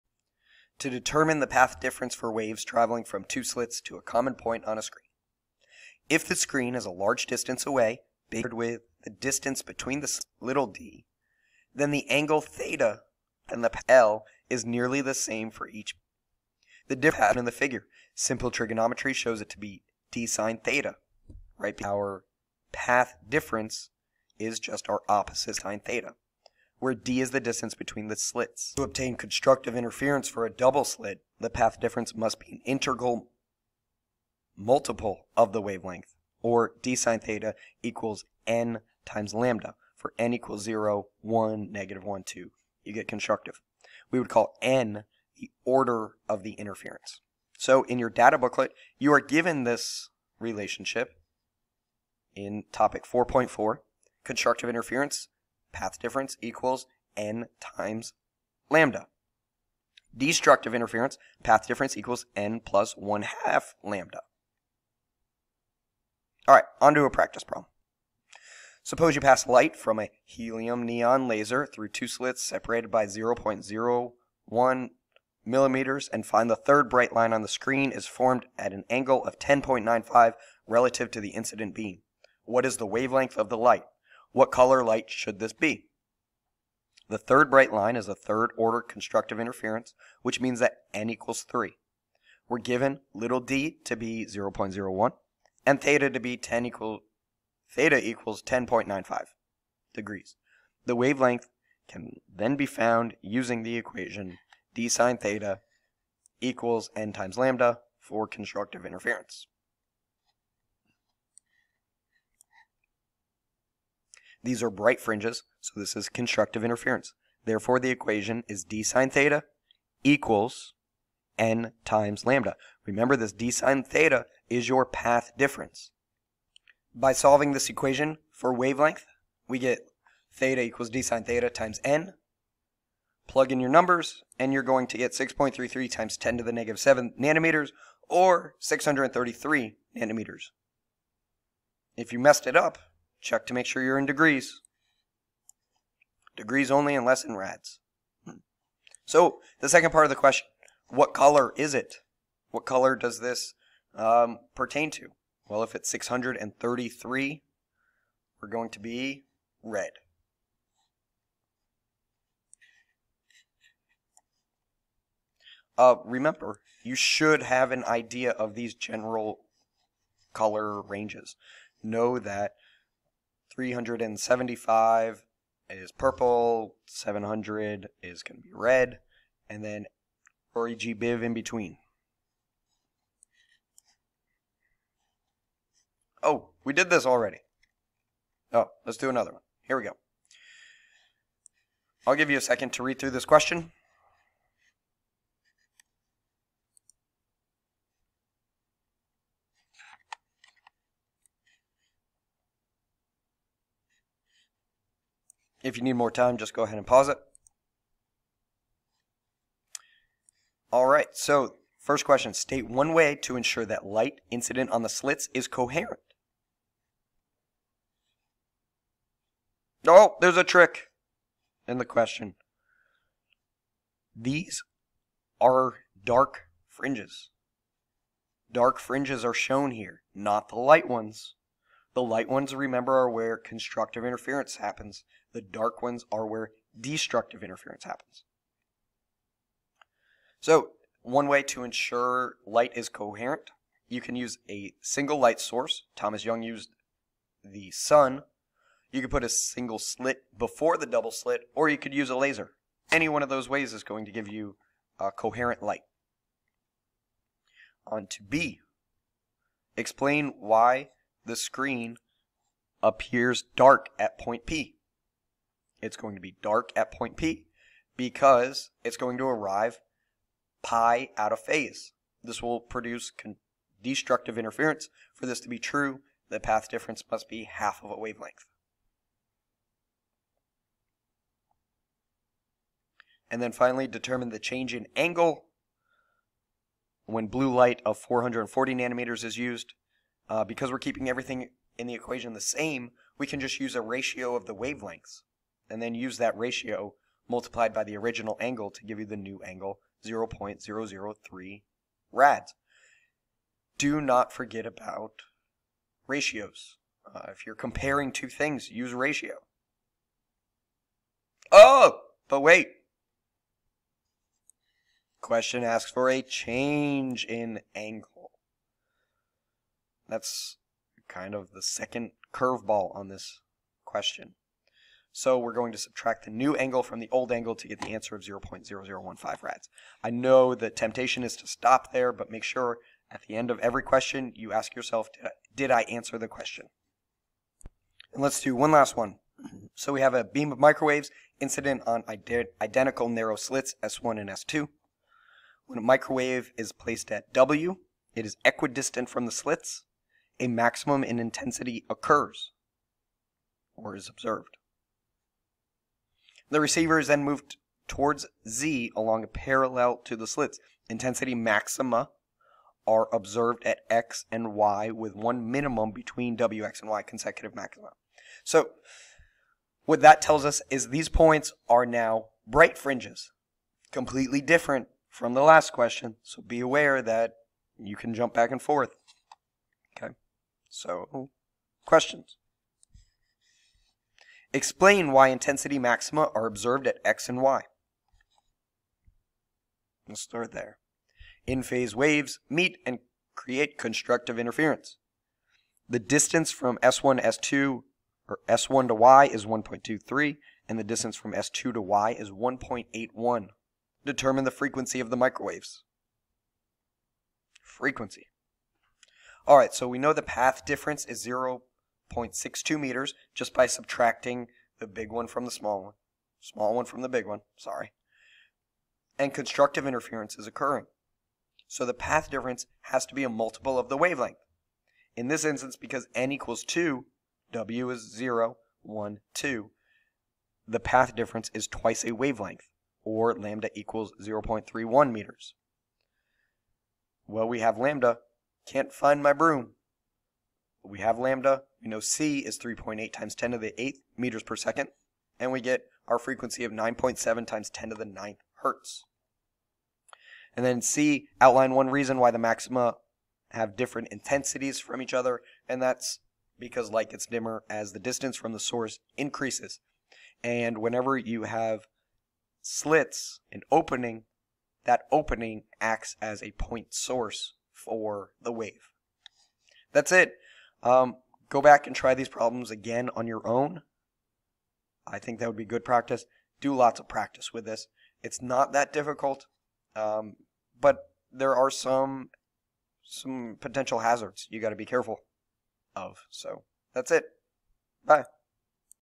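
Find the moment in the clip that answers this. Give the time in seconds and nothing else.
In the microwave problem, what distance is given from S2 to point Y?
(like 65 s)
402 s.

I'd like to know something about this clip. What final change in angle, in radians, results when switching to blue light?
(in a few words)
0.0015 rads.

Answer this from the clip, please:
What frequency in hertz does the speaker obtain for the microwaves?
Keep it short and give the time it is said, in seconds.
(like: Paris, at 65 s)
9.7 x 10^9 Hz, at 446 s.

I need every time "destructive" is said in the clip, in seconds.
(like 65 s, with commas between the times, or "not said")
60 s, 236 s, 273 s.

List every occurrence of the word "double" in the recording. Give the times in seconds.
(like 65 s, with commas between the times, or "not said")
30 s, 250 s.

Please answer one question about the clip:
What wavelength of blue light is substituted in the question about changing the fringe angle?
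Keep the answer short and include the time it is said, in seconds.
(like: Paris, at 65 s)
440 nanometers, at 287 s.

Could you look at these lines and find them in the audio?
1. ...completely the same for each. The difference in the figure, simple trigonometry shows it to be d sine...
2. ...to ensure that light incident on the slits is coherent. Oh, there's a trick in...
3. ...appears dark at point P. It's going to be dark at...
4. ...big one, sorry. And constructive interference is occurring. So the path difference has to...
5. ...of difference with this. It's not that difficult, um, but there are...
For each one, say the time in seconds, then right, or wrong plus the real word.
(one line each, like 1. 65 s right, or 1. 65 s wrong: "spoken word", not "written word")
1. 14 s wrong: "nearly", not "completely"
2. 213 s right
3. 262 s right
4. 417 s right
5. 476 s wrong: "practice", not "difference".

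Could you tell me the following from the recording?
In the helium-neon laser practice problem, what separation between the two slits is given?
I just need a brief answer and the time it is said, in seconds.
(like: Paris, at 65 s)
0.01 millimeters, at 73 s.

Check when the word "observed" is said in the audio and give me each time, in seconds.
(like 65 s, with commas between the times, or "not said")
354 s, 363 s, 386 s.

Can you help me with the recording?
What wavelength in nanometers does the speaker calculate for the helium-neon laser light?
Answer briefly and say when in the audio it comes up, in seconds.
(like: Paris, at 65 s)
633 nanometers, at 138 s.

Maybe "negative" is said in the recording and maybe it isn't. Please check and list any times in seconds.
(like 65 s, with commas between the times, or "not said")
41 s, 136 s.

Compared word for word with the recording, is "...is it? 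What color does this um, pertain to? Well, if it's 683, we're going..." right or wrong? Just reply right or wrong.
wrong.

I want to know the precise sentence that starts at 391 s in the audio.
In-phase waves meet and create constructive interference.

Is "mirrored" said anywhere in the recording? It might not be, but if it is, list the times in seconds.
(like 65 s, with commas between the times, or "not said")
not said.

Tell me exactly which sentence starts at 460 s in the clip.
And whenever you have slits, an opening, that opening acts as a point source for the wave.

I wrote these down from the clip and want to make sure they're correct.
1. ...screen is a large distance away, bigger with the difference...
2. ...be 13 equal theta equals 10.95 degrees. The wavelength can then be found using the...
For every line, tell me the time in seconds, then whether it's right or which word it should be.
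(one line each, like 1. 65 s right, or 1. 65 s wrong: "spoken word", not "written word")
1. 6 s wrong: "distance", not "difference"
2. 96 s wrong: "10", not "13".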